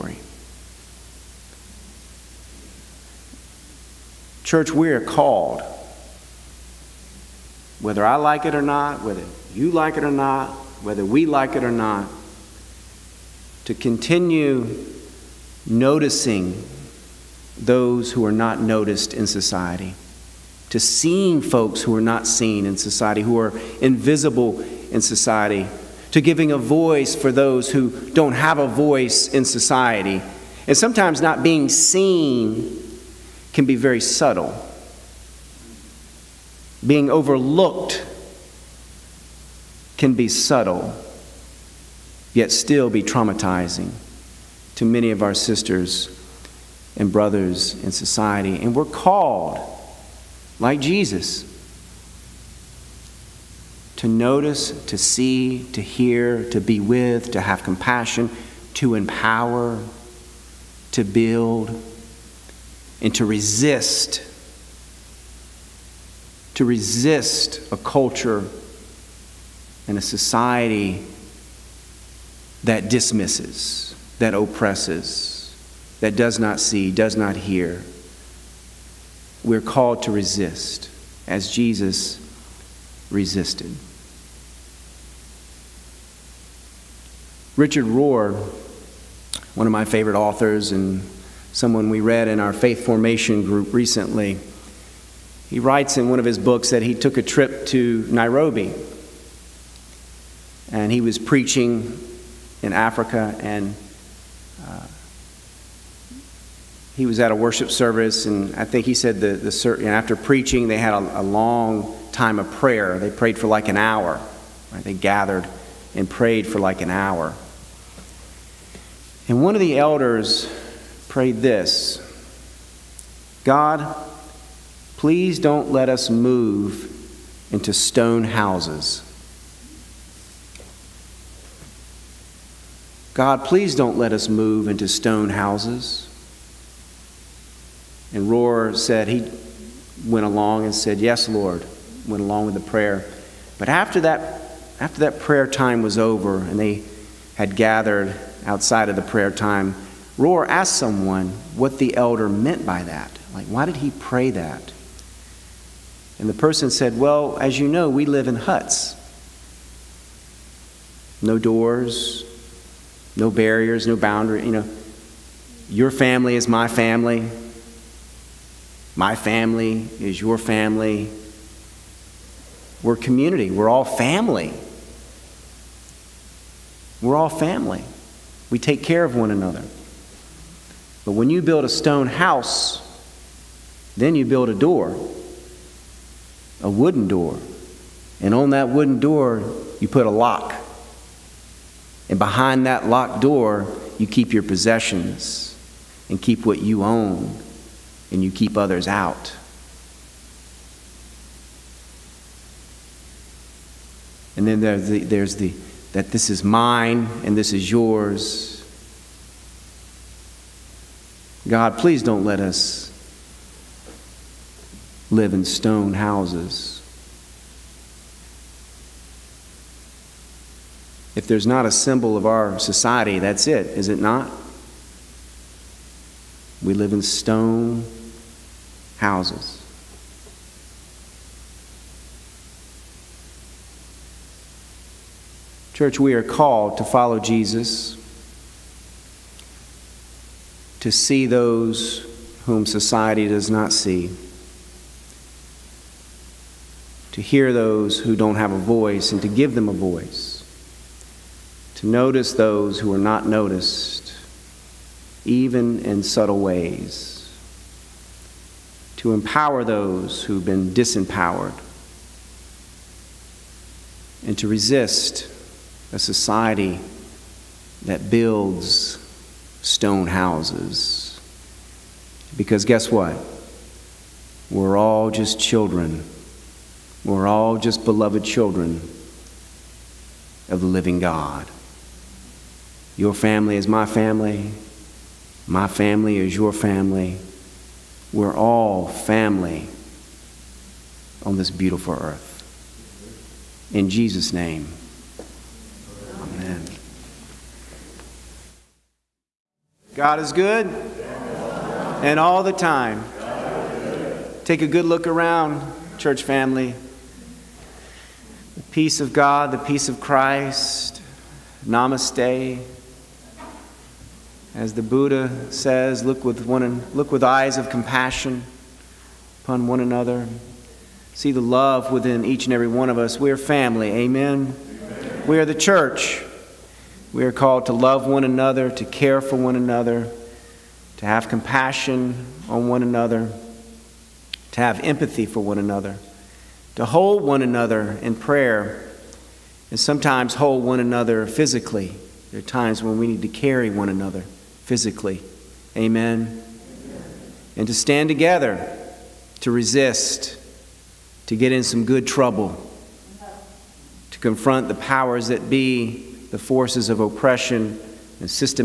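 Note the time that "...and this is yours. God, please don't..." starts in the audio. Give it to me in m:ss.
3:27.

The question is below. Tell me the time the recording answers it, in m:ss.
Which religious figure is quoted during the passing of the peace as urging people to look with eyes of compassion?
5:14.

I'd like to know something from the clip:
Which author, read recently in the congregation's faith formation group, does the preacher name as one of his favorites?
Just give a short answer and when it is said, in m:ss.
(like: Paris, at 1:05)
Richard Rohr, at 1:27.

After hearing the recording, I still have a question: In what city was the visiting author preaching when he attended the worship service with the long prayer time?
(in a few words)
Nairobi.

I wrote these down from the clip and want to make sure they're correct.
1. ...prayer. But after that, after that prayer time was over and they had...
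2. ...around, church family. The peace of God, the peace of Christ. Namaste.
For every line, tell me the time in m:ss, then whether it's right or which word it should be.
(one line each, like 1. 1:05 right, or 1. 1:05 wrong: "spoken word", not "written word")
1. 2:22 right
2. 5:05 right.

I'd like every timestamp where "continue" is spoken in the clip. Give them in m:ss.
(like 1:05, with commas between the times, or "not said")
0:13.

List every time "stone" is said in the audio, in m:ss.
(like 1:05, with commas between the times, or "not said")
2:07, 2:14, 3:01, 3:35, 3:47, 4:29.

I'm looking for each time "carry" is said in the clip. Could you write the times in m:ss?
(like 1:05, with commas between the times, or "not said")
5:43.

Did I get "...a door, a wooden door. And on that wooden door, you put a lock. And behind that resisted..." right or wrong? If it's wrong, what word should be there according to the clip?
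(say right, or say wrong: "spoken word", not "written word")
wrong: "locked", not "resisted".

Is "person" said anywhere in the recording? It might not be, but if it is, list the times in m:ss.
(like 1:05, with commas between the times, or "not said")
2:36.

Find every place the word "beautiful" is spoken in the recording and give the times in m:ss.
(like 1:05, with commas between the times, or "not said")
4:51.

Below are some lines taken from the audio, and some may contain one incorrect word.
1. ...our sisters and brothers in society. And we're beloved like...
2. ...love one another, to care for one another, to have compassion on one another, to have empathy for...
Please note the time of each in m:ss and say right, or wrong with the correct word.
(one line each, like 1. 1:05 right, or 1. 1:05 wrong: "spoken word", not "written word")
1. 0:45 wrong: "called", not "beloved"
2. 5:27 right.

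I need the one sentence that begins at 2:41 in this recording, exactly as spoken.
No doors, no barriers, no boundary.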